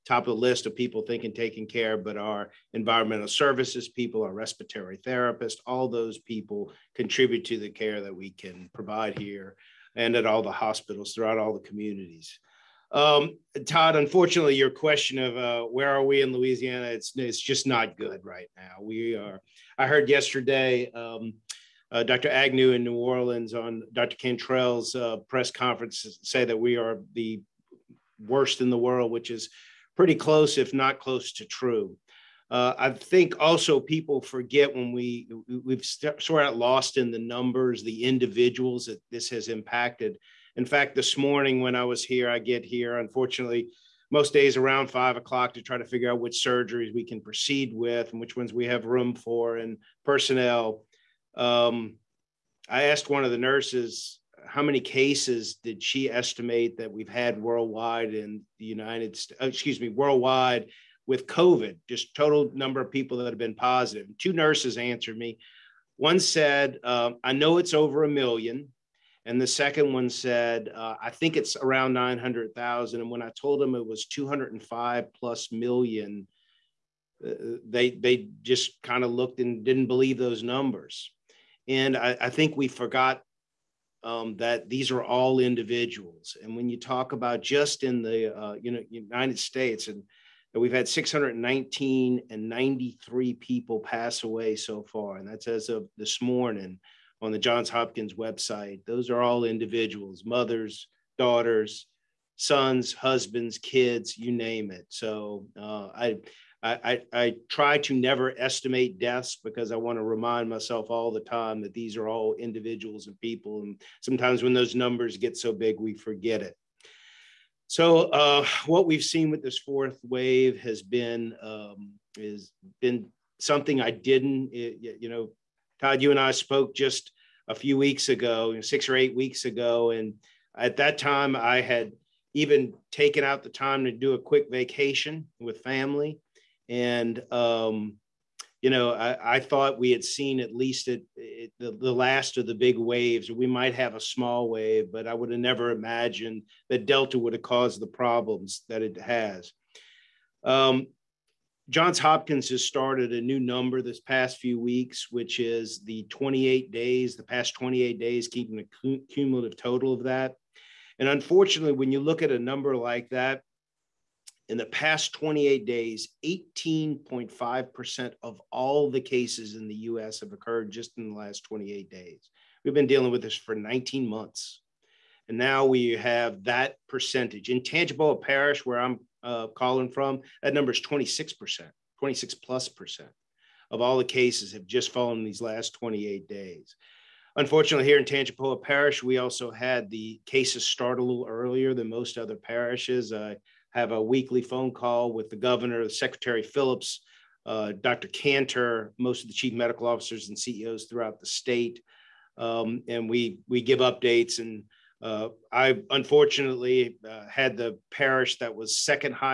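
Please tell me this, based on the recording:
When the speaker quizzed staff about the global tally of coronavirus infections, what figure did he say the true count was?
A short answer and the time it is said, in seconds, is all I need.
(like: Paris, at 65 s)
205 million, at 74 s.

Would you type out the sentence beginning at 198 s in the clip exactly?
Kanter, most of the chief medical officers and CEOs throughout the state.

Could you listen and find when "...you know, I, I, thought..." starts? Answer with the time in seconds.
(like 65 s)
138 s.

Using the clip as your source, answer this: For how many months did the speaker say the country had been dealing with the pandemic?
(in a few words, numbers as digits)
19.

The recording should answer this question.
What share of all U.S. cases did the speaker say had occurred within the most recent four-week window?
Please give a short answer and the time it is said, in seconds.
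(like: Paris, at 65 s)
18.5%, at 166 s.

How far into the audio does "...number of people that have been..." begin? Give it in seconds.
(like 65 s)
62 s.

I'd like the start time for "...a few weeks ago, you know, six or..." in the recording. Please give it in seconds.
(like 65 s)
127 s.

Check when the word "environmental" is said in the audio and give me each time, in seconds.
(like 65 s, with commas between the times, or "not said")
2 s.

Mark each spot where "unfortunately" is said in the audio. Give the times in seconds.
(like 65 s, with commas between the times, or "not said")
13 s, 42 s, 161 s, 187 s, 205 s.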